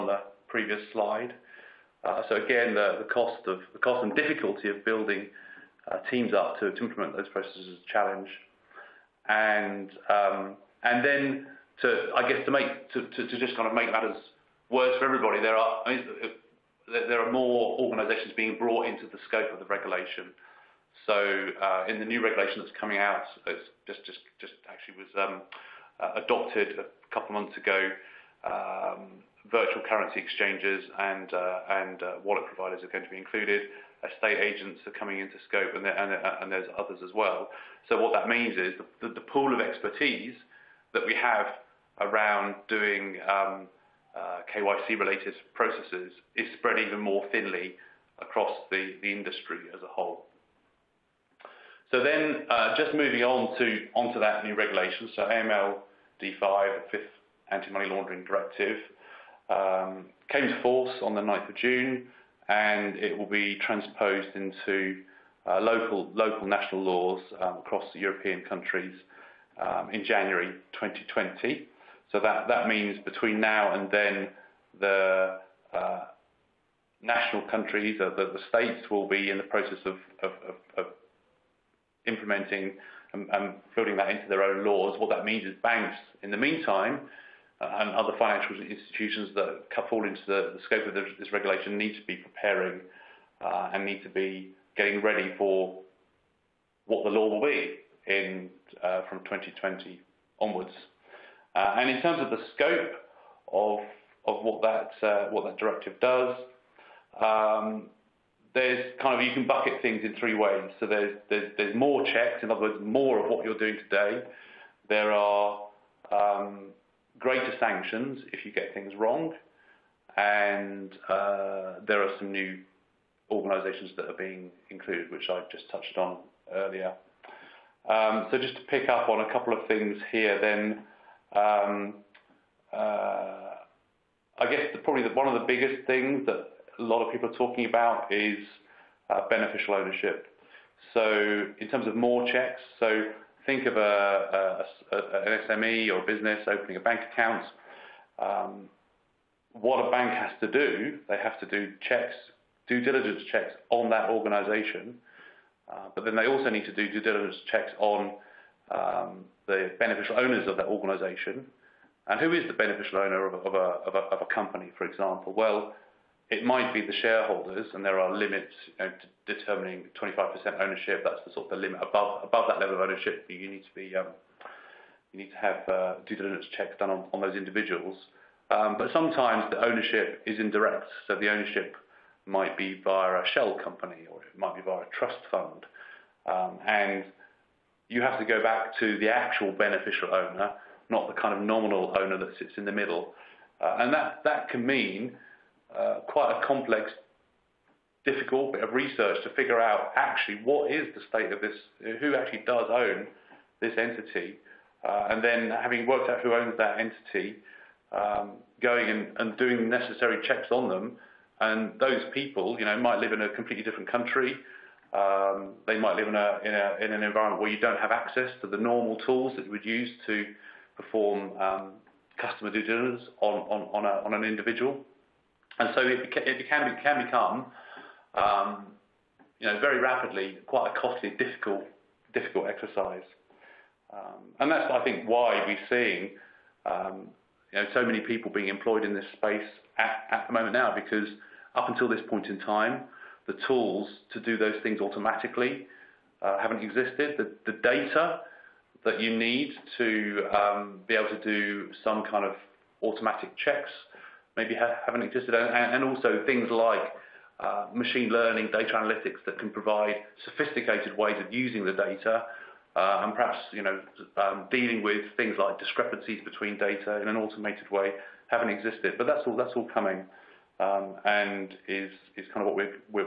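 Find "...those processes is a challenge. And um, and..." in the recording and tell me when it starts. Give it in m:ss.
0:07.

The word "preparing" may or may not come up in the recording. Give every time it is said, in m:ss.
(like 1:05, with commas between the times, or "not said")
1:32.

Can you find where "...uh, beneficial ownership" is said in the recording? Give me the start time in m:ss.
2:19.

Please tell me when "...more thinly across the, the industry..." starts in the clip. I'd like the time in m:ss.
0:46.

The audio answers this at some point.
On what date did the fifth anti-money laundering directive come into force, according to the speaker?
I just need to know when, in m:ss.
1:01.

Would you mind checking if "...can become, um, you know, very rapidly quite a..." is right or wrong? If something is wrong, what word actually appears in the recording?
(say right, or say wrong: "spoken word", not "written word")
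right.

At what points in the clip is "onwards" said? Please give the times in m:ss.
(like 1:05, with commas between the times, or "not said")
1:40.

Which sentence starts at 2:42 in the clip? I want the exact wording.
And who is the beneficial owner of, of, a, of, a, of a company, for example?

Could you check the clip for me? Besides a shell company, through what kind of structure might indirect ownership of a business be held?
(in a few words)
trust fund.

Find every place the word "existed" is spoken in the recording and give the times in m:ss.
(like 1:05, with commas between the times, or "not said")
4:06, 4:15, 4:28.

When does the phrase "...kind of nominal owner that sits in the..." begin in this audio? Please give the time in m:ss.
3:11.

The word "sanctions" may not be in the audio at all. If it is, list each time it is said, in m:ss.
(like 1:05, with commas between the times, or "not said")
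1:57.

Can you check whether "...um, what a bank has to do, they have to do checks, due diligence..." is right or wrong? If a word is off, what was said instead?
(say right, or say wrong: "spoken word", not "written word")
right.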